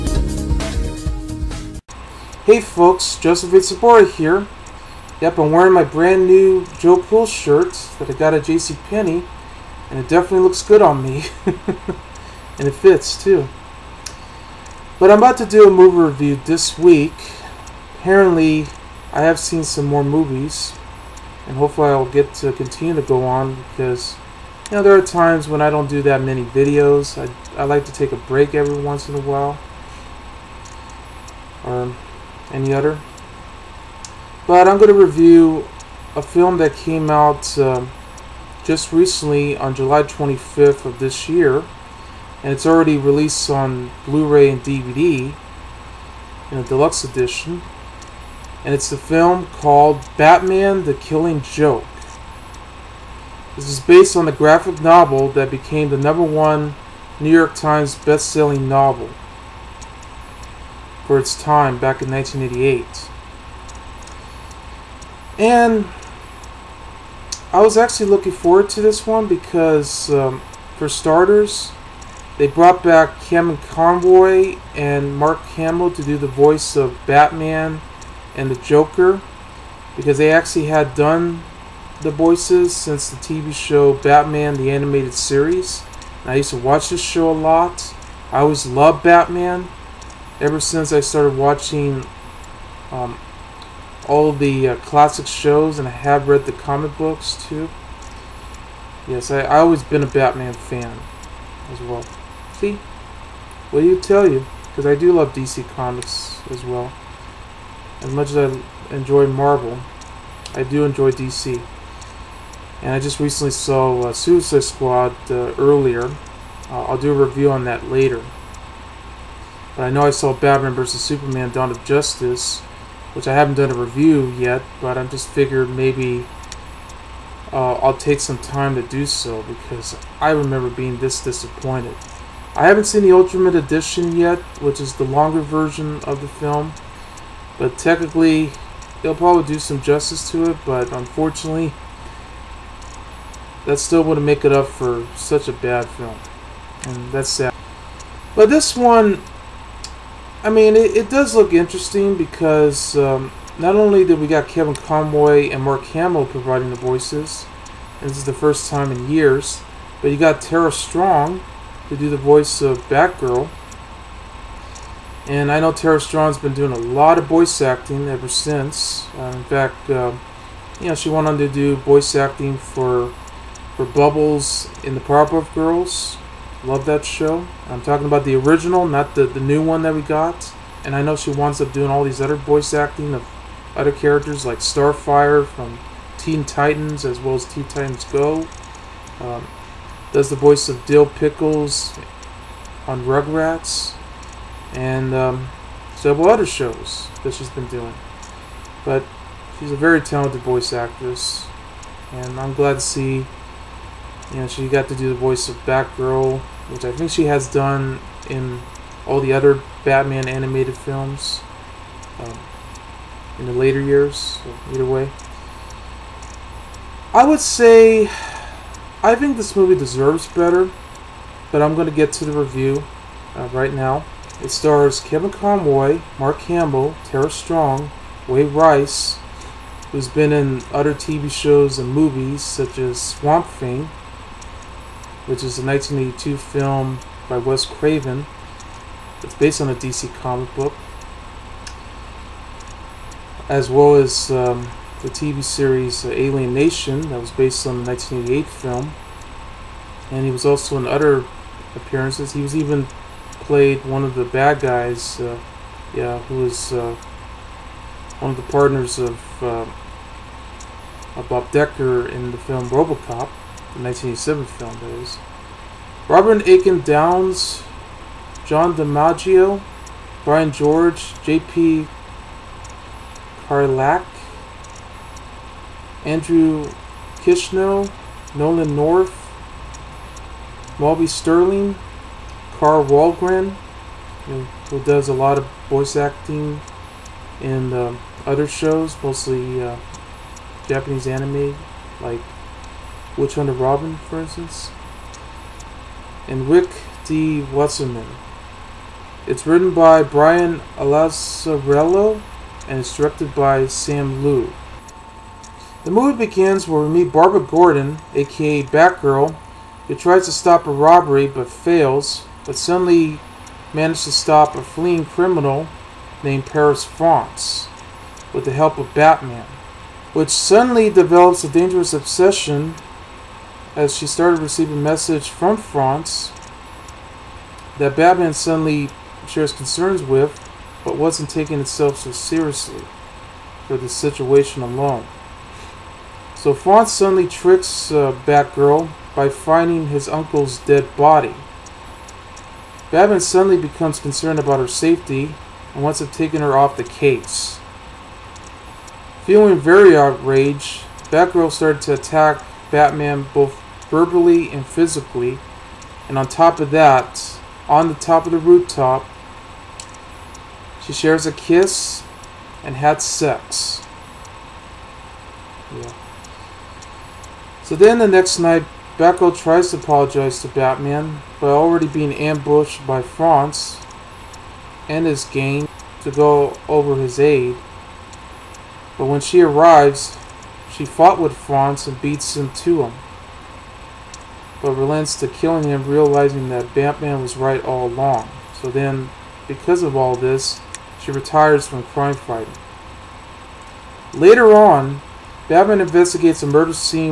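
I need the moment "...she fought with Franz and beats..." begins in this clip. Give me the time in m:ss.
6:20.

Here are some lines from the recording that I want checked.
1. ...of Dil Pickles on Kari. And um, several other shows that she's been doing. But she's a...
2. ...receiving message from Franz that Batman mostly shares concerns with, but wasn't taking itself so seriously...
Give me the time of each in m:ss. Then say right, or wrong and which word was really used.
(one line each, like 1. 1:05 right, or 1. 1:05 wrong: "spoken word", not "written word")
1. 3:10 wrong: "Rugrats", not "Kari"
2. 5:24 wrong: "suddenly", not "mostly".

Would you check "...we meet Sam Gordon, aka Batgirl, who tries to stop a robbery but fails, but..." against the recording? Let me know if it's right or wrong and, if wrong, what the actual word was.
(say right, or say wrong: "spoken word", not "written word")
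wrong: "Barbara", not "Sam".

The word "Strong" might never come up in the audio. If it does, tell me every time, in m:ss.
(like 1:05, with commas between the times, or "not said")
2:40, 2:45, 3:47.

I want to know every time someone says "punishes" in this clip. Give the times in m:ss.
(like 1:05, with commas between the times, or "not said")
not said.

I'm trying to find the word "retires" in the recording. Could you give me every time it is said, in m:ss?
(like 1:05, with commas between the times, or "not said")
6:31.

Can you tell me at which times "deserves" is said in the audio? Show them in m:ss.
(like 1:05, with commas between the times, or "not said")
3:39.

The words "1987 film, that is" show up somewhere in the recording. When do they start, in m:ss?
4:23.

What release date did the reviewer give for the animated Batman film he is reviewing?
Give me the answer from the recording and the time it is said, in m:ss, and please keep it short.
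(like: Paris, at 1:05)
July 25, at 0:39.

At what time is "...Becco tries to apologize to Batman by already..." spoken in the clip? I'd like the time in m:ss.
6:08.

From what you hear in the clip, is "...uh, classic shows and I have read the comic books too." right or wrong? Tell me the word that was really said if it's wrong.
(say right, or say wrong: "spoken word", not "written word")
right.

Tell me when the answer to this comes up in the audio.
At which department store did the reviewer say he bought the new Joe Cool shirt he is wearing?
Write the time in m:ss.
0:08.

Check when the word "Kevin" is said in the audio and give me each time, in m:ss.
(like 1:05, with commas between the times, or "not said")
1:13, 2:34, 3:44.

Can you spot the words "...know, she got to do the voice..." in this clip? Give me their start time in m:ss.
3:24.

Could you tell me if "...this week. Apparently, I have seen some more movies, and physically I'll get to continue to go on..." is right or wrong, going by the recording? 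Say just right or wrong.
wrong.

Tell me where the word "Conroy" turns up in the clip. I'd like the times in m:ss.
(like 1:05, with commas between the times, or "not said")
1:13, 2:34, 3:45.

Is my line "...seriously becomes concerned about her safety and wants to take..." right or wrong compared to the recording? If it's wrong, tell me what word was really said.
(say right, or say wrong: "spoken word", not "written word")
wrong: "suddenly", not "seriously".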